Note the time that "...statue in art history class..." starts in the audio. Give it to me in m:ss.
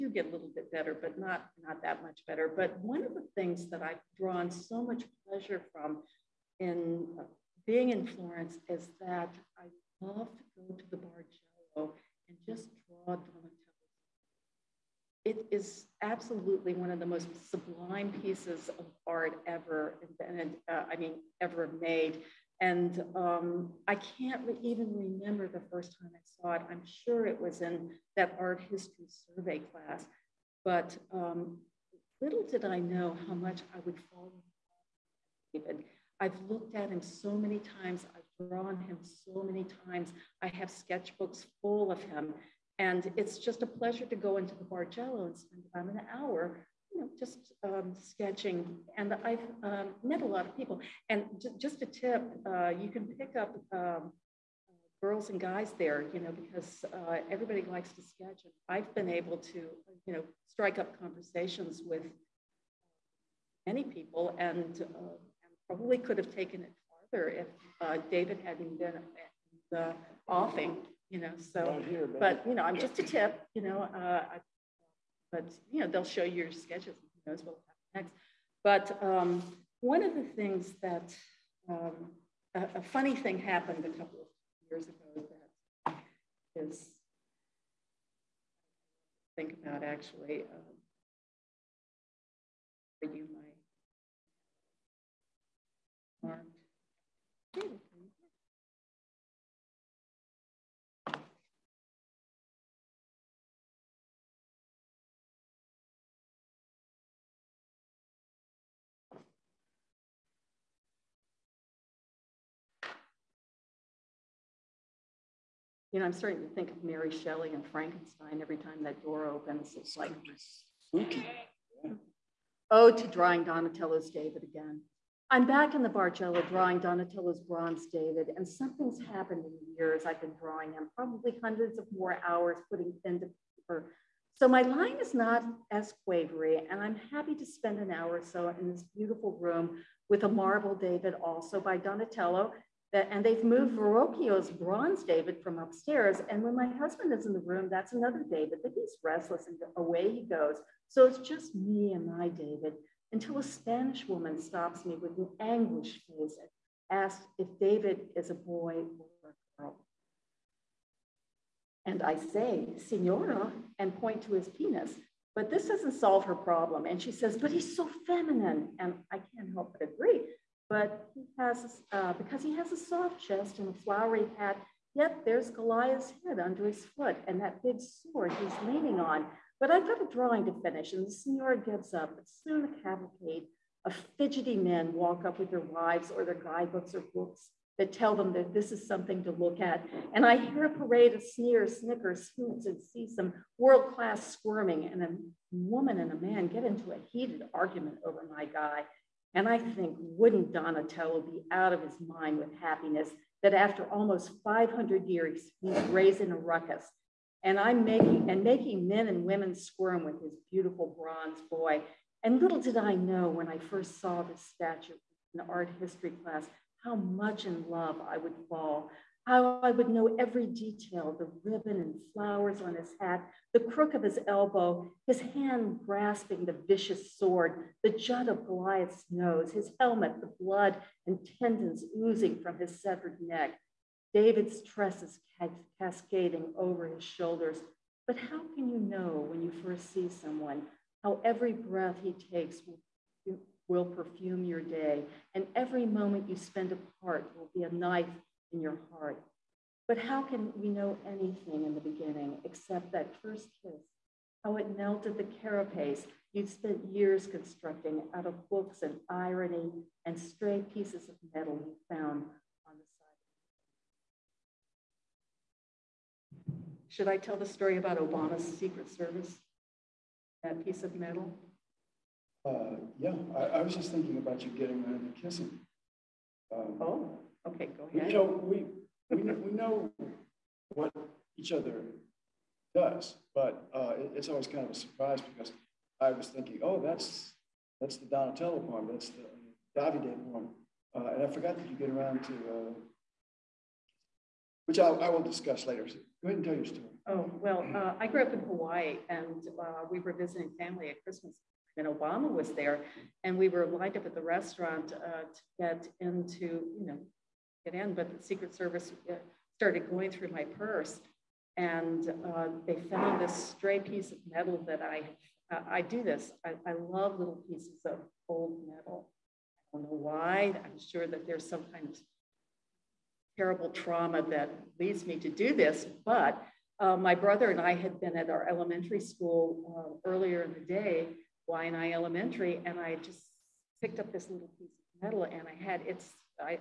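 3:34.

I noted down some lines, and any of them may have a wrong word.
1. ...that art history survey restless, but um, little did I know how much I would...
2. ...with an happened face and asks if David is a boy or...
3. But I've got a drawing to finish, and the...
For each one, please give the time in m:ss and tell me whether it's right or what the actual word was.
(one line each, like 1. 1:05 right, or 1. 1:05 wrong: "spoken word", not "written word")
1. 0:28 wrong: "class", not "restless"
2. 2:34 wrong: "anguished", not "happened"
3. 2:59 right.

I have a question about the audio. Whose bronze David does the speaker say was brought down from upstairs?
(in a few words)
Verrocchio.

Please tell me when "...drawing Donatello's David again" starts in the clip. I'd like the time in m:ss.
2:03.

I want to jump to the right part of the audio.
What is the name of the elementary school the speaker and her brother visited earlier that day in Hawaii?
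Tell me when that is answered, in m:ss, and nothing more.
5:31.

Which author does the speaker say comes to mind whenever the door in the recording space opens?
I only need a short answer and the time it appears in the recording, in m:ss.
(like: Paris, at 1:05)
Mary Shelley, at 1:56.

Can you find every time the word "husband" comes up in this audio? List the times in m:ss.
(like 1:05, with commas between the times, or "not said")
2:26.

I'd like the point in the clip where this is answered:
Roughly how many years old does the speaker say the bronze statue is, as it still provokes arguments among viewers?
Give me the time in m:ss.
3:24.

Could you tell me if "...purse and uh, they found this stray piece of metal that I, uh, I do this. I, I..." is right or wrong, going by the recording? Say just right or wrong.
right.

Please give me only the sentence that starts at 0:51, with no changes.
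And just a tip, uh, you can pick up um, girls and guys there, you know, because uh, everybody likes to sketch.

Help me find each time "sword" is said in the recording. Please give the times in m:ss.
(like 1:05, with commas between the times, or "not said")
2:57, 3:47.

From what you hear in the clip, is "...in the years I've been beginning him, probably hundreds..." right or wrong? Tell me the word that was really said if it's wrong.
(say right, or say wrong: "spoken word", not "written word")
wrong: "drawing", not "beginning".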